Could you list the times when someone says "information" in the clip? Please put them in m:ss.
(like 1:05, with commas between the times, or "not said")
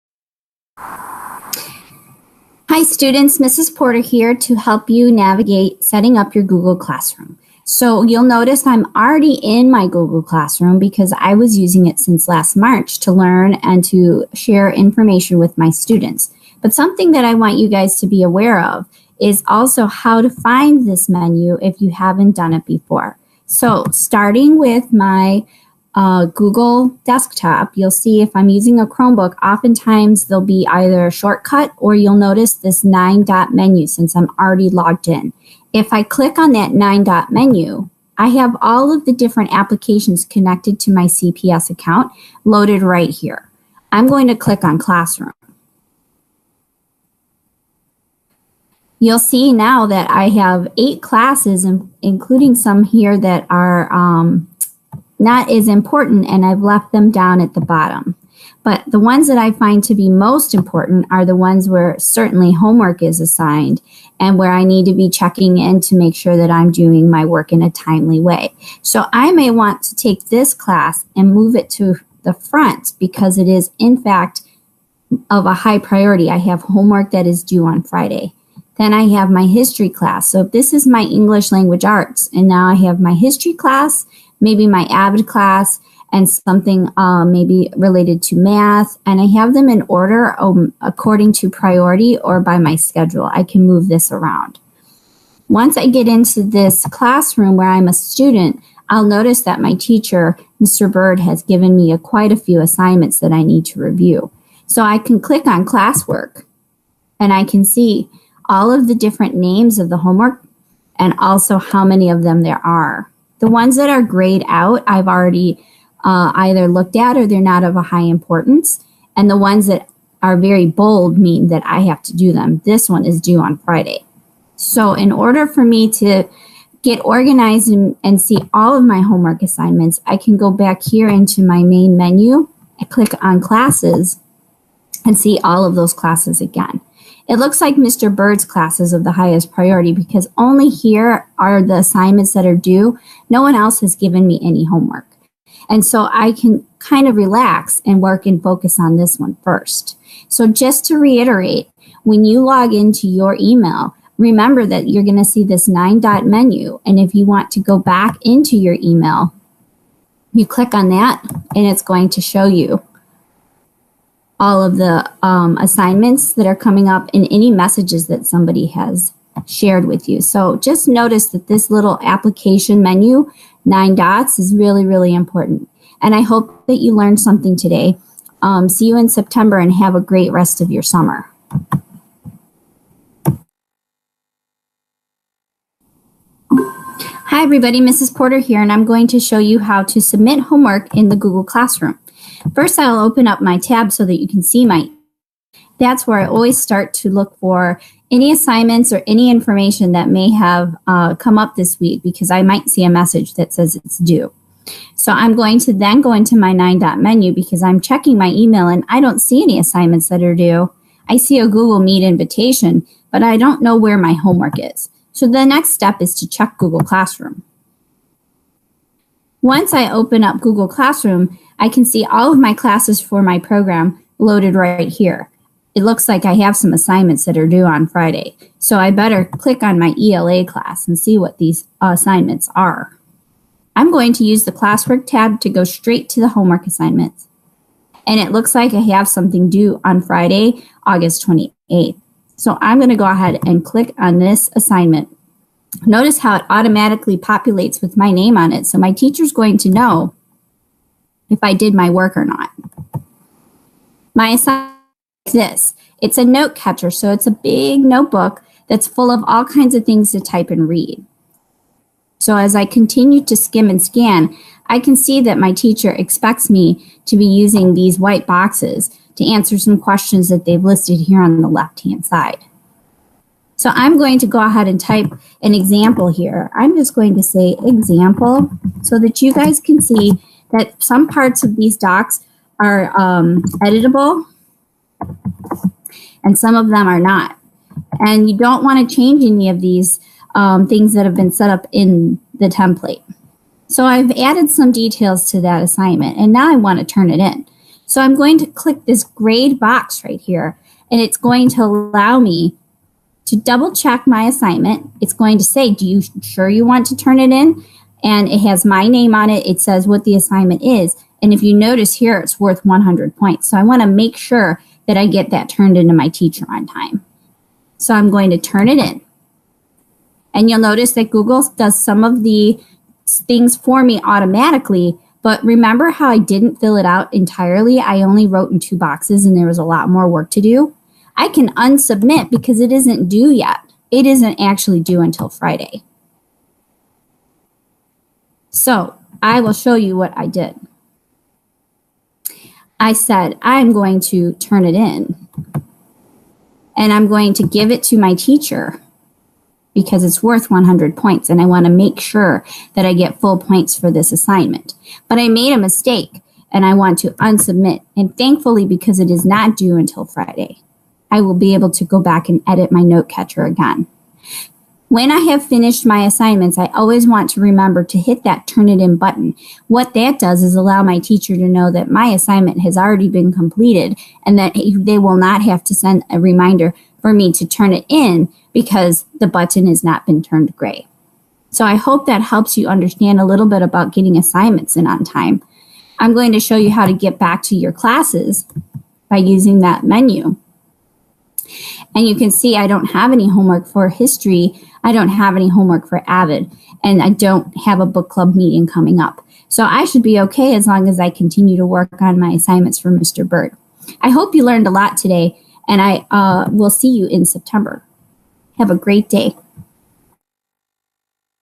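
0:14, 3:19.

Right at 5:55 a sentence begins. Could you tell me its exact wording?
But I made a mistake and I want to unsubmit.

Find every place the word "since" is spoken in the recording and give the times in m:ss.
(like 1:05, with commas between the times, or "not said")
0:11, 0:33.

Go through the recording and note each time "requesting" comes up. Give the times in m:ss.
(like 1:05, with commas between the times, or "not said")
not said.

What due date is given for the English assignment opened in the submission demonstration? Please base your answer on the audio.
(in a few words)
Friday, August 28th.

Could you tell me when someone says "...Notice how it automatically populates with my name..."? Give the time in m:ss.
4:05.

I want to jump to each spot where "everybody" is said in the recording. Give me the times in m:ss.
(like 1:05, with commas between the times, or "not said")
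3:07.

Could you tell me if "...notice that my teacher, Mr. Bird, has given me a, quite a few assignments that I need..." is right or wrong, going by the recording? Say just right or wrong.
right.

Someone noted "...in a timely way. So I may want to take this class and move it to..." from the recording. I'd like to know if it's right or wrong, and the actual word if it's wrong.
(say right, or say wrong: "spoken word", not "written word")
right.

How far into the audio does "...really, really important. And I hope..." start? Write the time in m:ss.
2:54.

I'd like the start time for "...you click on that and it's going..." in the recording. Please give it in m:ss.
2:40.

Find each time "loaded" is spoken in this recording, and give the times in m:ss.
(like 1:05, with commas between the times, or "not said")
0:42, 3:44.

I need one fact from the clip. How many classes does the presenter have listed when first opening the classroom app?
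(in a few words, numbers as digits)
8.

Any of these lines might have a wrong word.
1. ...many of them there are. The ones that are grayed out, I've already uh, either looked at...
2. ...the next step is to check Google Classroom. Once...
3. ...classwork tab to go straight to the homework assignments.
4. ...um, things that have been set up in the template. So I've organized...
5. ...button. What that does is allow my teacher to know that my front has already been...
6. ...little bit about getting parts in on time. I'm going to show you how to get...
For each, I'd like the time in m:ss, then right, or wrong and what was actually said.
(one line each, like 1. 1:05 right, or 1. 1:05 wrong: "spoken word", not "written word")
1. 1:51 right
2. 3:35 right
3. 3:54 right
4. 4:50 wrong: "added", not "organized"
5. 6:08 wrong: "assignment", not "front"
6. 6:23 wrong: "assignments", not "parts".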